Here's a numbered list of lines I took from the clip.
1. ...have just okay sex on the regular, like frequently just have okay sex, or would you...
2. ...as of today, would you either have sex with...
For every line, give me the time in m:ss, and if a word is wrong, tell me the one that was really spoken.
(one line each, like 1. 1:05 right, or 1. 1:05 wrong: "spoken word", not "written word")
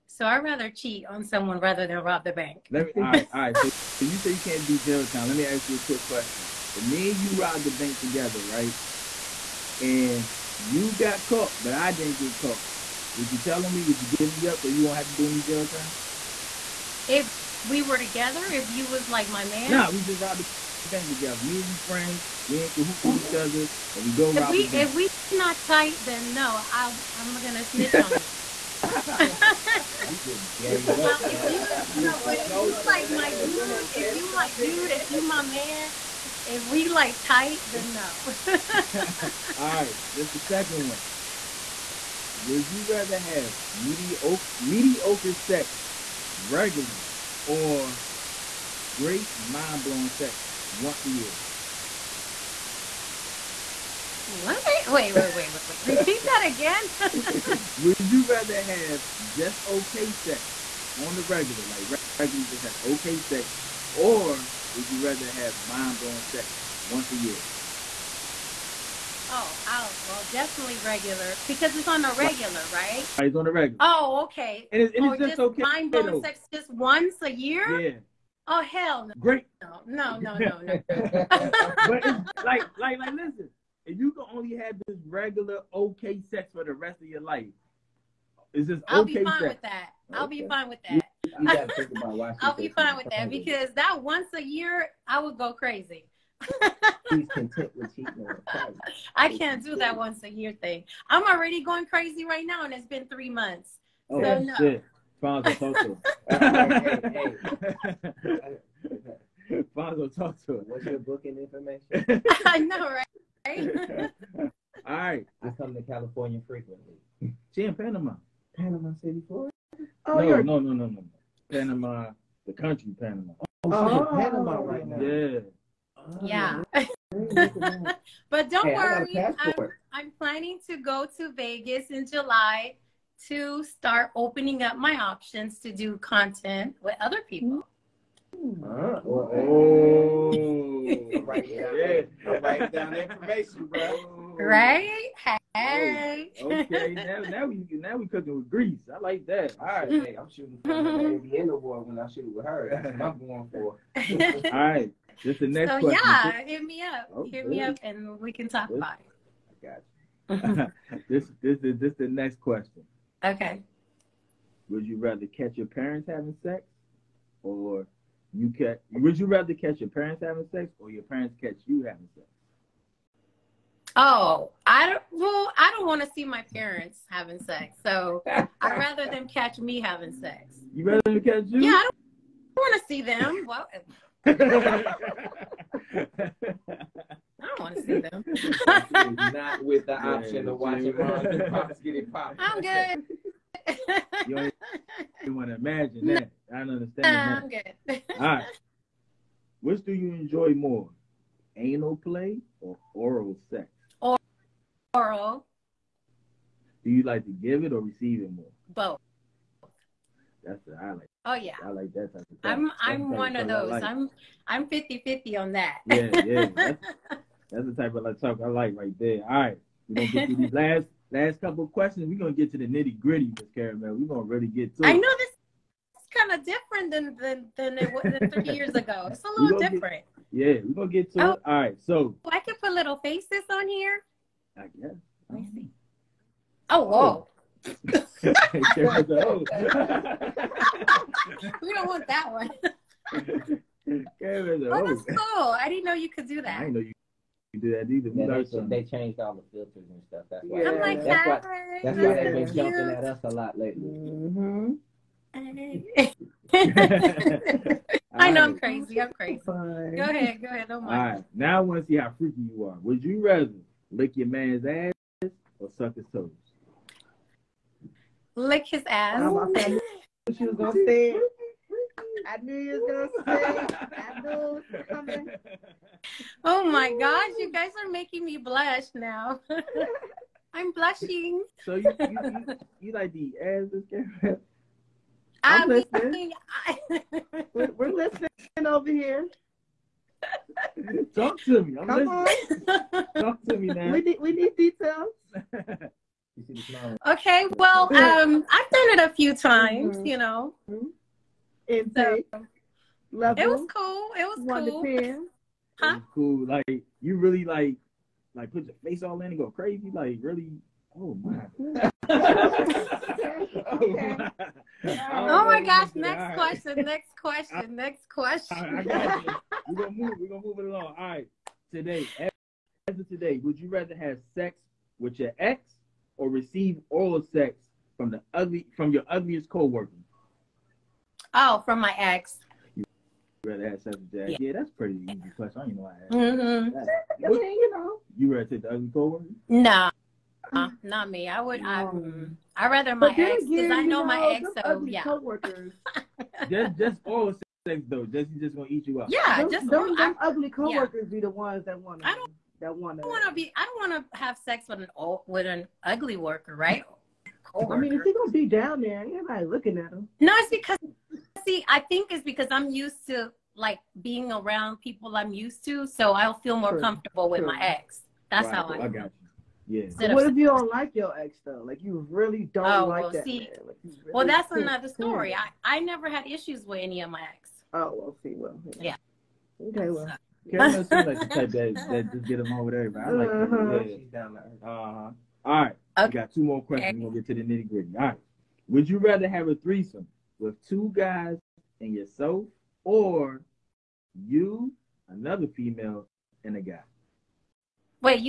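1. 0:58 wrong: "regularly", not "frequently"
2. 5:22 wrong: "rather", not "either".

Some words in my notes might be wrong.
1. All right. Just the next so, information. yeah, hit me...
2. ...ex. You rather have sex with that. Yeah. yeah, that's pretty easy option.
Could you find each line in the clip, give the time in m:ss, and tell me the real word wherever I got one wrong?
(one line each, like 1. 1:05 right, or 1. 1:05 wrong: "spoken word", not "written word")
1. 2:34 wrong: "question", not "information"
2. 5:31 wrong: "question", not "option".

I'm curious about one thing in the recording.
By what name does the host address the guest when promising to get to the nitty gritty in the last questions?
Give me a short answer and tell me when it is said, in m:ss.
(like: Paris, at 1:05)
Miss Caramel, at 3:43.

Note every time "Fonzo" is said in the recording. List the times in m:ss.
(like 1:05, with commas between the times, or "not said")
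1:45, 1:49.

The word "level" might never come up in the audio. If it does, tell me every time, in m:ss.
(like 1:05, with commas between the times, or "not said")
5:03.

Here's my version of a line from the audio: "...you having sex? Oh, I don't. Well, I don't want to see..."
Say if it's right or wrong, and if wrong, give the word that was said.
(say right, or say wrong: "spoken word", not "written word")
right.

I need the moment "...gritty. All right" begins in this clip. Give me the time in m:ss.
6:27.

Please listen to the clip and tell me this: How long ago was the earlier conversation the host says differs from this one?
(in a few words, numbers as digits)
3 years ago.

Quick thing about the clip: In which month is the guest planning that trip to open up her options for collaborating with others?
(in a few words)
July.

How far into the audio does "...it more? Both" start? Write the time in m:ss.
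3:28.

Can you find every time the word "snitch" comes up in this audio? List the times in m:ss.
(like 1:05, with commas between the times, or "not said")
0:27.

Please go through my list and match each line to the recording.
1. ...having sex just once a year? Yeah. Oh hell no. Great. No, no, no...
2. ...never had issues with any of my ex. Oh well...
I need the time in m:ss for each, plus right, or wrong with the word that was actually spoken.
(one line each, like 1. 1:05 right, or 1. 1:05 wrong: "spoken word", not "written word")
1. 1:15 wrong: "blowing", not "having"
2. 6:15 right.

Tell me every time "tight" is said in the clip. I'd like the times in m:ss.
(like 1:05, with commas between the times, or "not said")
0:25, 0:37.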